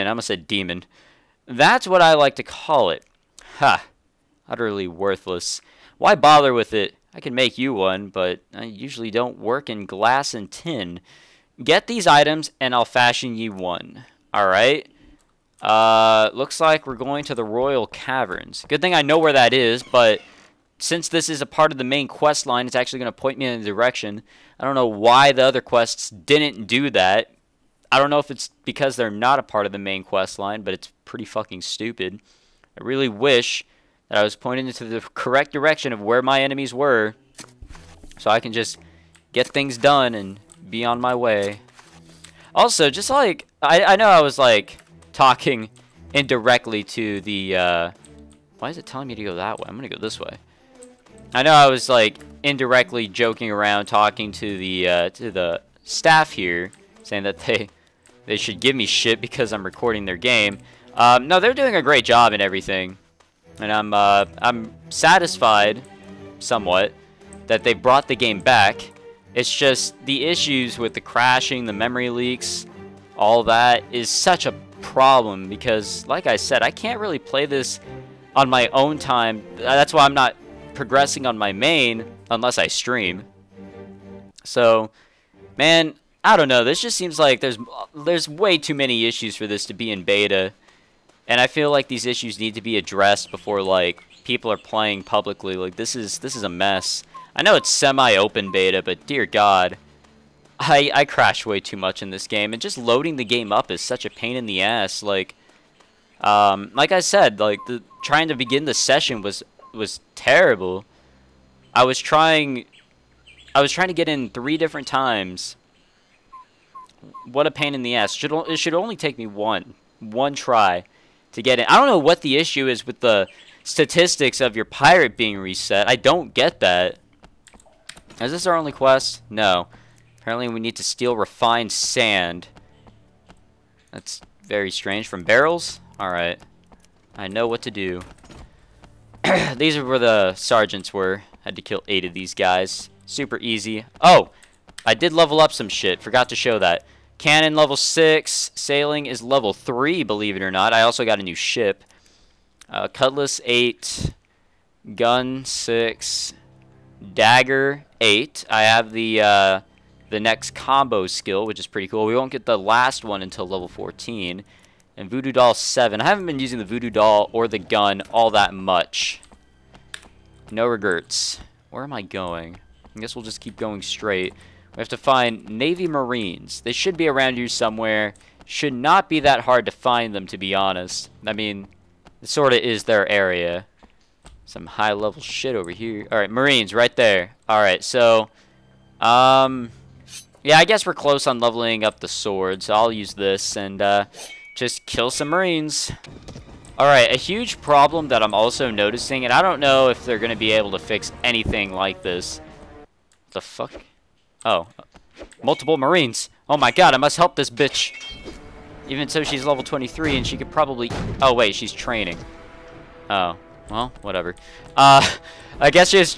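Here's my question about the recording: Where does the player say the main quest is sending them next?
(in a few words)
Royal Caverns.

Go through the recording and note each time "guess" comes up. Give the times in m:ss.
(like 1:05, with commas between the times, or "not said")
2:53, 3:10.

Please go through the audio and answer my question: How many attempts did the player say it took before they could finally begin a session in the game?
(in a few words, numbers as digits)
3.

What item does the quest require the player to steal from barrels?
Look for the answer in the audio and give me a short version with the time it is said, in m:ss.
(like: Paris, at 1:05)
Refined sand, at 2:11.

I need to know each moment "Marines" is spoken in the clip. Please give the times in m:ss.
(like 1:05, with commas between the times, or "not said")
2:55, 3:06, 3:15, 3:25.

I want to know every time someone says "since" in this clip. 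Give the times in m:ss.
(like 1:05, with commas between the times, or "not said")
0:20.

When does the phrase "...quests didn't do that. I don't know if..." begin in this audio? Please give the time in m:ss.
0:25.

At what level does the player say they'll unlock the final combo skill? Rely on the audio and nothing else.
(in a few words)
14.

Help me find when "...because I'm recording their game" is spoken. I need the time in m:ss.
0:59.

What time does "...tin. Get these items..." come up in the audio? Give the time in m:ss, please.
0:10.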